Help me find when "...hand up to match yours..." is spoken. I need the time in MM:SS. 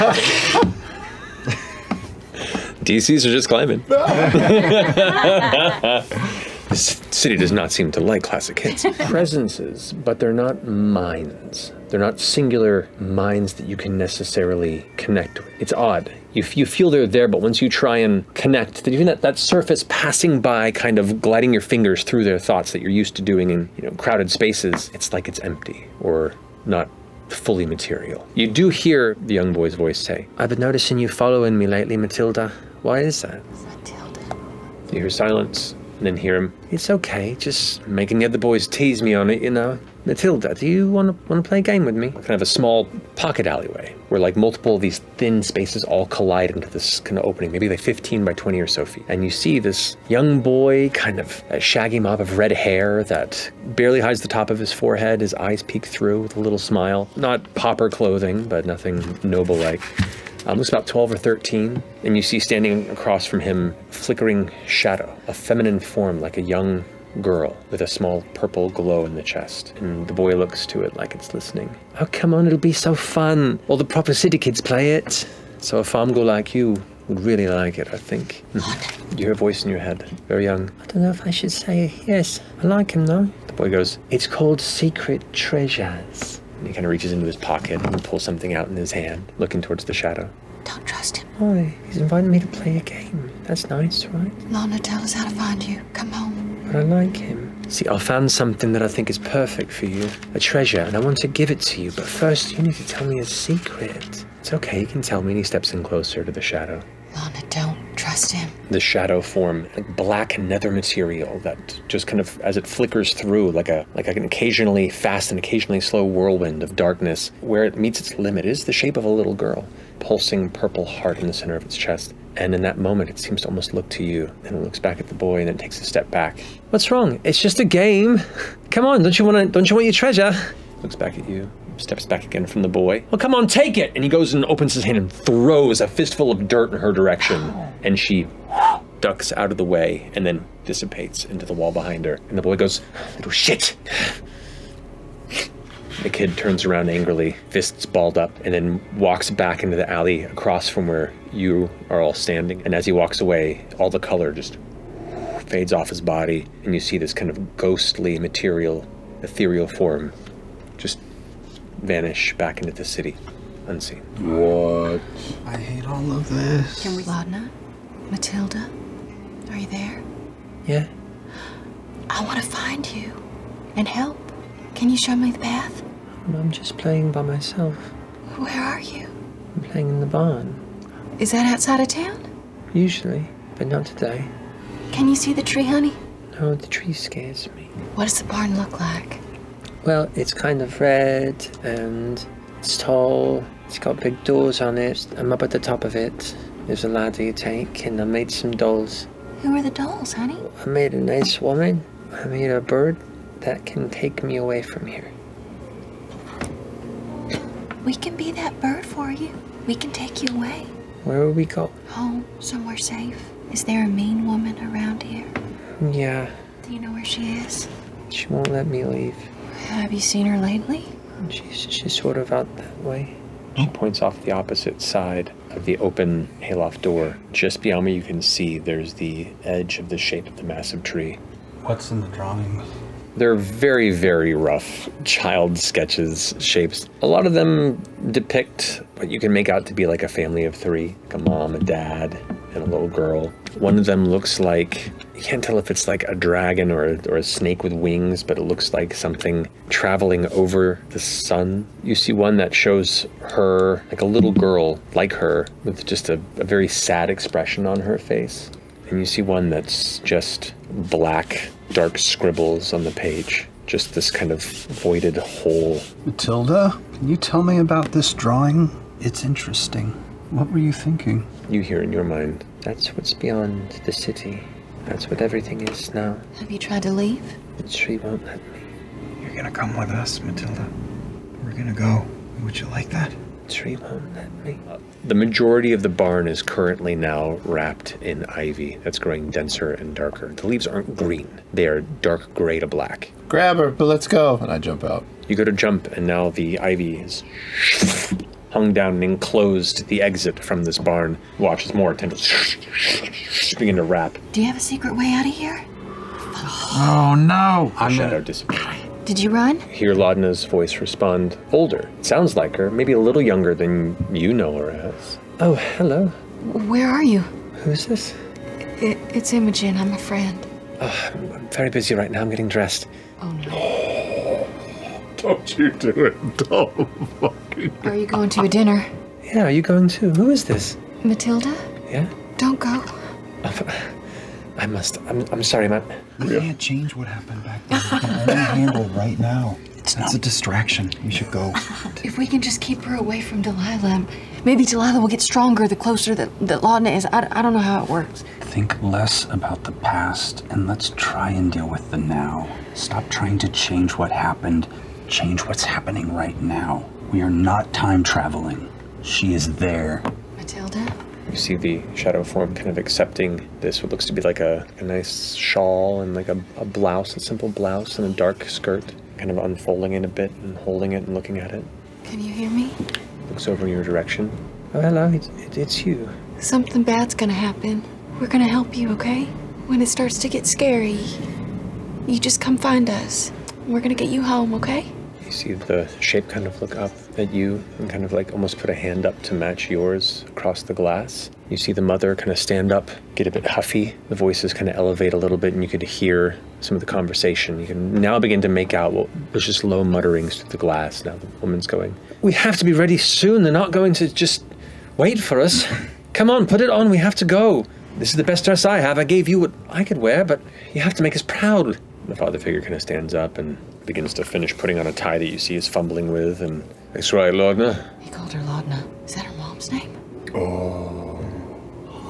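06:28.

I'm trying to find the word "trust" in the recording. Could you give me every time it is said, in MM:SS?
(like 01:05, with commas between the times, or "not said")
01:30, 01:48.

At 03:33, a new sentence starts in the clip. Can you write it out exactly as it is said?
Is there a mean woman around here?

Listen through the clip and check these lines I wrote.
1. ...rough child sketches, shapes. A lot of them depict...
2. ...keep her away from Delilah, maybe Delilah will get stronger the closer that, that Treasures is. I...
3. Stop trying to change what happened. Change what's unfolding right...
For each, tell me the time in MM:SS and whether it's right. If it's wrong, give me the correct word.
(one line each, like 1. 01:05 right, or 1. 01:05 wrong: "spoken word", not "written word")
1. 03:54 right
2. 05:42 wrong: "Laudna", not "Treasures"
3. 05:52 wrong: "happening", not "unfolding".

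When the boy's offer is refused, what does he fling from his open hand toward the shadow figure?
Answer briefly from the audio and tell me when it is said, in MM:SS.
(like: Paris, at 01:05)
A fistful of dirt, at 02:15.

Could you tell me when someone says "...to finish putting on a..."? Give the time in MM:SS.
06:54.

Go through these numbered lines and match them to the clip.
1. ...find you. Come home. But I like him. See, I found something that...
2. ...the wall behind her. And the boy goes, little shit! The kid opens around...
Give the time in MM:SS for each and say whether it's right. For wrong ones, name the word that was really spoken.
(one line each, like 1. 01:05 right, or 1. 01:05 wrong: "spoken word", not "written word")
1. 01:35 right
2. 02:21 wrong: "turns", not "opens".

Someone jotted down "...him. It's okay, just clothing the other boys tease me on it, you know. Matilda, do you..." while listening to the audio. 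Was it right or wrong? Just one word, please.
wrong.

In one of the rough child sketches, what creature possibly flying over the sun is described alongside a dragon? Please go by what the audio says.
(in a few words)
A snake with wings.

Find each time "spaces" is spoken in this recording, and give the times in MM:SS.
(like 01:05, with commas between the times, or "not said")
00:24, 00:45.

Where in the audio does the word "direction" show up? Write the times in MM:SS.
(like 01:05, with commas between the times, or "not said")
02:16, 06:13.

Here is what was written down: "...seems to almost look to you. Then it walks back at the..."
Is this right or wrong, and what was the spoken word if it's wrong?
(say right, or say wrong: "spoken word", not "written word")
wrong: "looks", not "walks".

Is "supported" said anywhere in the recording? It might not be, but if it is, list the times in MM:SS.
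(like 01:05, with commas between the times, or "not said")
not said.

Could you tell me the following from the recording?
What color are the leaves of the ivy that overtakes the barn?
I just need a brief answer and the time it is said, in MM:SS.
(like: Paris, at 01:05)
Dark gray to black, at 04:51.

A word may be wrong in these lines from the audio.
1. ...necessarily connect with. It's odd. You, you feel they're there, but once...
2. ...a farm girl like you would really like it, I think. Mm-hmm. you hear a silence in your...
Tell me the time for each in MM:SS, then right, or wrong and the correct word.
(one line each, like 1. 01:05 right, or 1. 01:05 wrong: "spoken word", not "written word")
1. 00:13 right
2. 01:15 wrong: "voice", not "silence".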